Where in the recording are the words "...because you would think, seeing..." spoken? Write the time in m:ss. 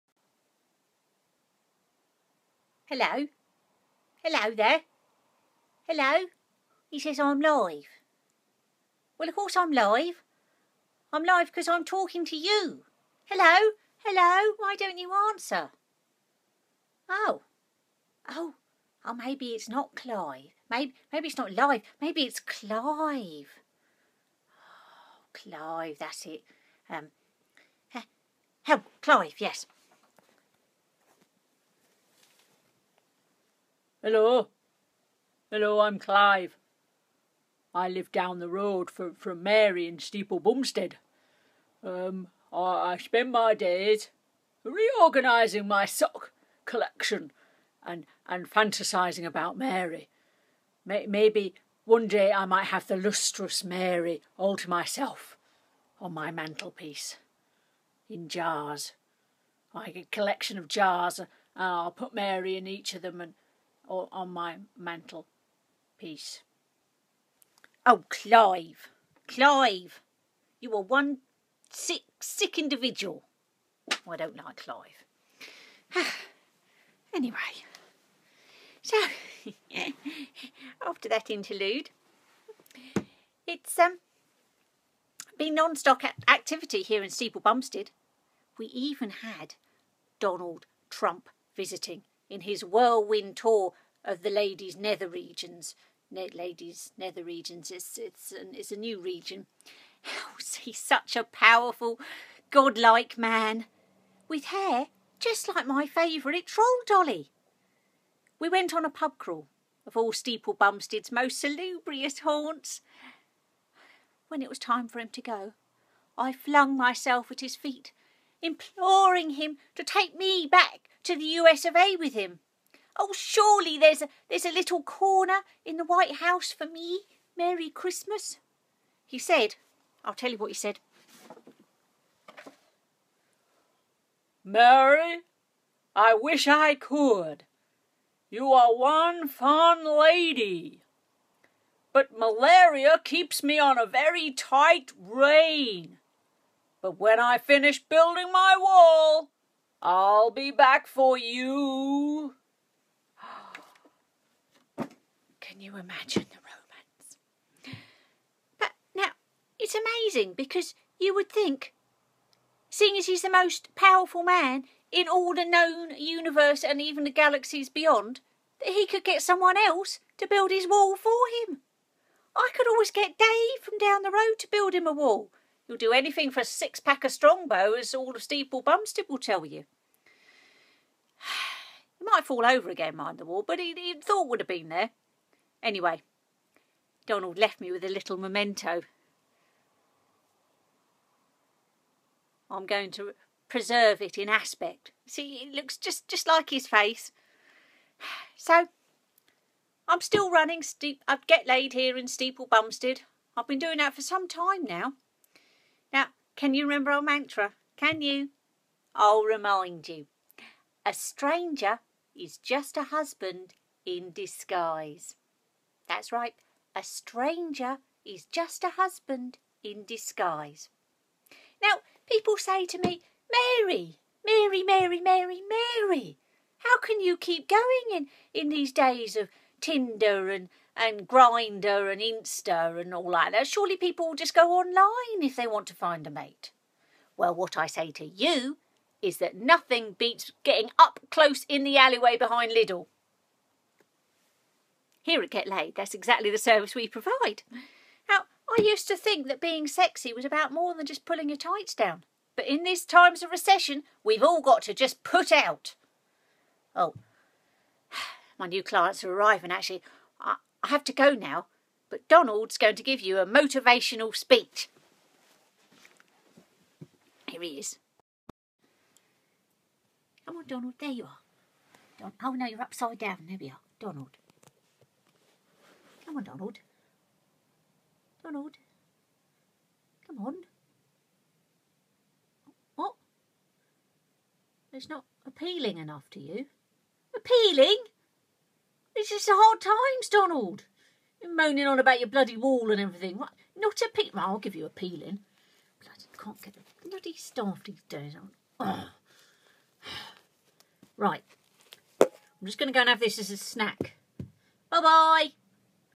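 2:40.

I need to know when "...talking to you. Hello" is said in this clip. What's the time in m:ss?
0:11.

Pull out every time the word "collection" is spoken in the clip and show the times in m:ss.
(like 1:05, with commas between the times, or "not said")
0:46, 1:00.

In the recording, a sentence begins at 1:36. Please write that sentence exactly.
Ne- ladies' nether regions, it's, it's, an, it's a new region.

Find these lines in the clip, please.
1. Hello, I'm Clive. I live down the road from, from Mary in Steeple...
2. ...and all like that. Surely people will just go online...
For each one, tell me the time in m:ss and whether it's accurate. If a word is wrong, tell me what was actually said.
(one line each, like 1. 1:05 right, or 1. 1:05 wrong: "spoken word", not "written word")
1. 0:35 right
2. 3:52 right.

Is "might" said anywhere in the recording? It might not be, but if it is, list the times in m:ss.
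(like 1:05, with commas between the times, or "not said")
0:52, 3:02.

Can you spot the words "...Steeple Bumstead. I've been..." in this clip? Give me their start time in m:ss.
3:22.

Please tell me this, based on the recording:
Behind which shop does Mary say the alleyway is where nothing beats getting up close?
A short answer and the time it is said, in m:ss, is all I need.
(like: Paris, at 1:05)
Lidl, at 4:02.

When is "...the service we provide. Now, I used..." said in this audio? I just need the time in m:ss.
4:06.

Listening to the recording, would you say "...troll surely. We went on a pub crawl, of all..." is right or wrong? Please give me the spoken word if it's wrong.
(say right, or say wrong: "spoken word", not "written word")
wrong: "dolly", not "surely".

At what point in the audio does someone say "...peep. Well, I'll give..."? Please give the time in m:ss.
4:53.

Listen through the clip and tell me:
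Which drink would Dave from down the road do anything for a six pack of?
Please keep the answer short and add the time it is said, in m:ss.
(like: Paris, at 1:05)
Strongbow, at 2:57.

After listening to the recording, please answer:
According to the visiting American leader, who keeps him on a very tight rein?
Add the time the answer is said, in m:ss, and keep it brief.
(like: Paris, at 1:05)
Melania, at 2:22.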